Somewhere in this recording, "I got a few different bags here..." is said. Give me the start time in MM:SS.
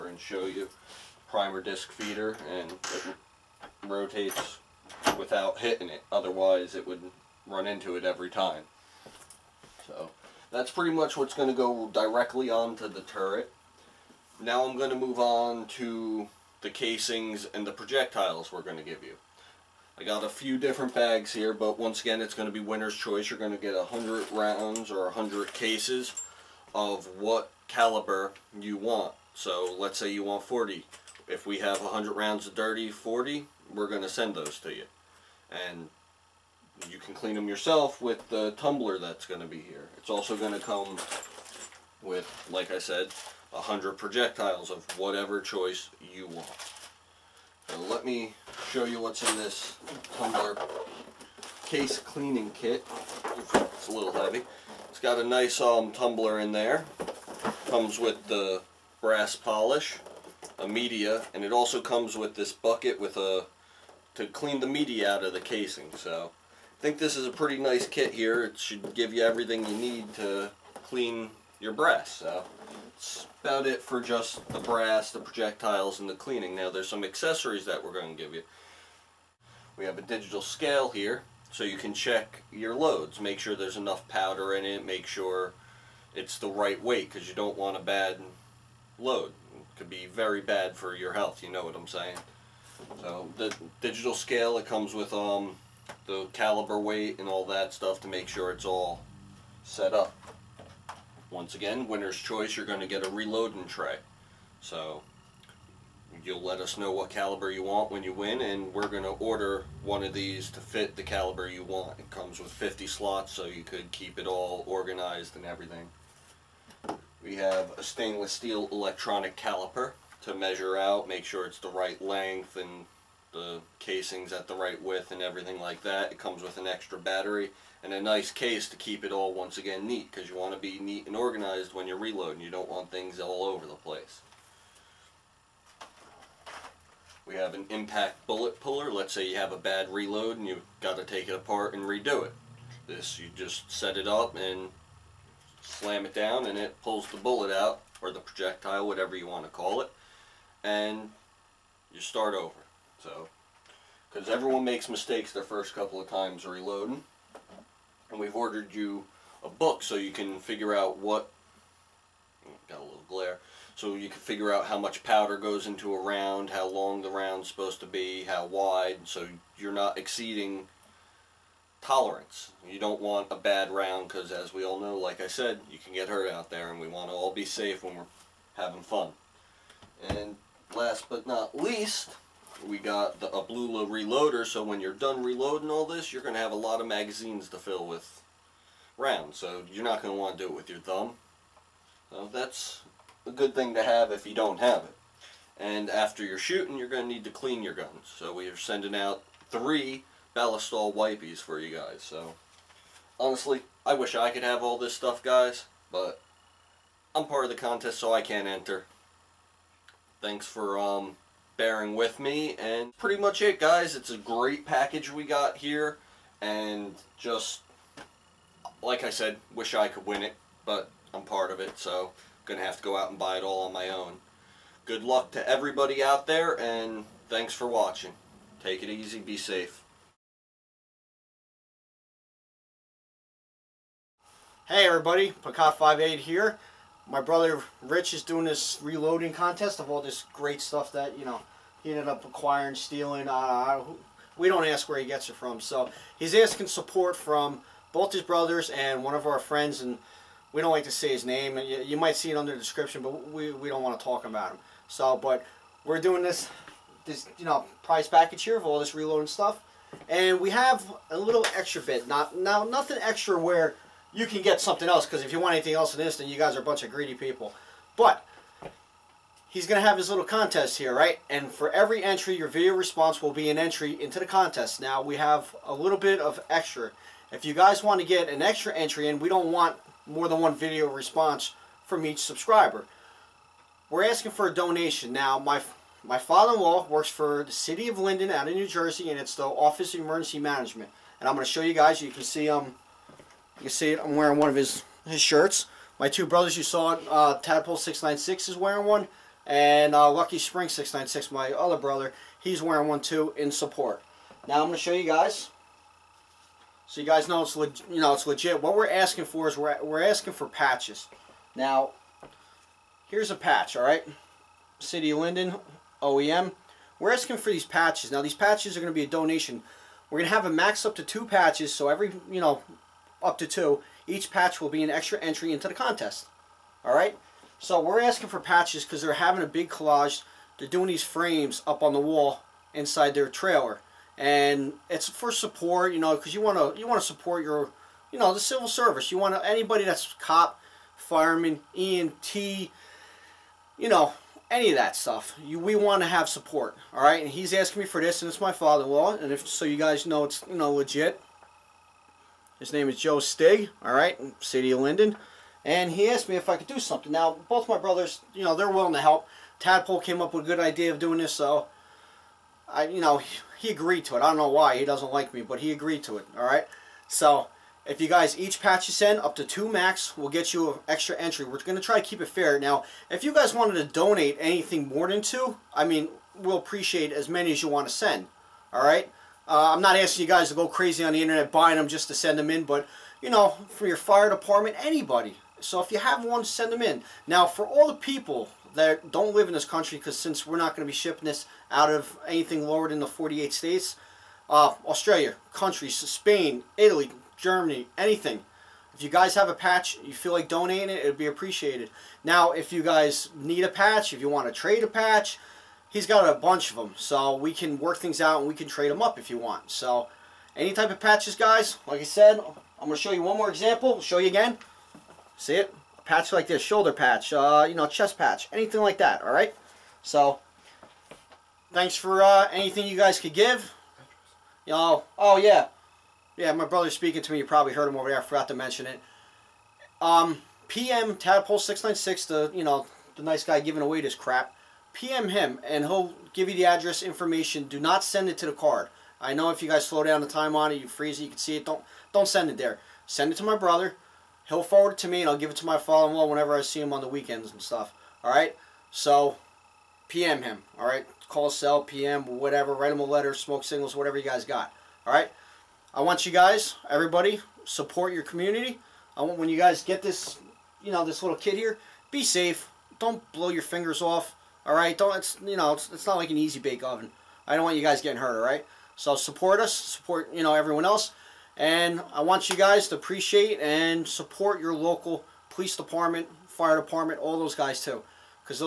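00:19.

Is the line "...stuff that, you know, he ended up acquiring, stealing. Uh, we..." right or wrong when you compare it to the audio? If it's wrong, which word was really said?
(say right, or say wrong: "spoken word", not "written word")
right.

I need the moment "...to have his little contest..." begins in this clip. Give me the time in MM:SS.
04:29.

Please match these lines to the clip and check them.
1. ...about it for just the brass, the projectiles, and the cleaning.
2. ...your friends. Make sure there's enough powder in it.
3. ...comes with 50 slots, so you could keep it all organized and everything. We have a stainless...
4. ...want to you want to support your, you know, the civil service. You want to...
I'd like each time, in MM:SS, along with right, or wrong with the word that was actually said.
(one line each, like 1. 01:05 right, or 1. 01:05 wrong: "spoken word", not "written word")
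1. 01:13 right
2. 01:22 wrong: "loads", not "friends"
3. 01:52 right
4. 05:36 right.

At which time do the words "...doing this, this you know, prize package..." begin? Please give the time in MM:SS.
04:16.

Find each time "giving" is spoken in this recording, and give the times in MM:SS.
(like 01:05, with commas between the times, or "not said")
07:13.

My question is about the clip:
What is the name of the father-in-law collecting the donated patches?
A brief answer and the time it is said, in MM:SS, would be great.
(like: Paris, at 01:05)
Joe Stig, at 05:52.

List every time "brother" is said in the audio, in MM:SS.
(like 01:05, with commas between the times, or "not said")
03:57, 04:08, 04:56, 05:01, 05:57, 07:06, 07:23.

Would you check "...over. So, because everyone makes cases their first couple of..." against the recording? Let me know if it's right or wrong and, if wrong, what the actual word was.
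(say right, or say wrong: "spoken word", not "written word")
wrong: "mistakes", not "cases".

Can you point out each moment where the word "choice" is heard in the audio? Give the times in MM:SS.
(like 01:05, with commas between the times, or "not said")
00:22, 00:45, 01:42.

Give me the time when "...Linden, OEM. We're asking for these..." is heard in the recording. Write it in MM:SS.
05:15.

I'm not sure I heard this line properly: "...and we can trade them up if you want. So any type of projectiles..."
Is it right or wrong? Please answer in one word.
wrong.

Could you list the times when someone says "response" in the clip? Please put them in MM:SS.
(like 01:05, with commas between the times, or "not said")
04:32, 04:40.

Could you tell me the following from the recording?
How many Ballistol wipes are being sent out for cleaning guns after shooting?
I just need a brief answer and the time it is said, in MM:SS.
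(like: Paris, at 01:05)
3, at 03:19.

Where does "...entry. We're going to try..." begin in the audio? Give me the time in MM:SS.
06:11.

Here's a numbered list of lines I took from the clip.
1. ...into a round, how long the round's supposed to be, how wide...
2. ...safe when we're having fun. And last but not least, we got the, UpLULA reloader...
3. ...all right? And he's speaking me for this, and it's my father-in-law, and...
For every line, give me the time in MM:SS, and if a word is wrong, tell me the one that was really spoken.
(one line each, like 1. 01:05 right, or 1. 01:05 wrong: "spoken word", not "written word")
1. 02:45 right
2. 02:57 right
3. 05:46 wrong: "asking", not "speaking".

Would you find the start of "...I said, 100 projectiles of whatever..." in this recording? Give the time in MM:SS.
00:42.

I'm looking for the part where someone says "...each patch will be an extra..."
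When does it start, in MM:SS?
05:24.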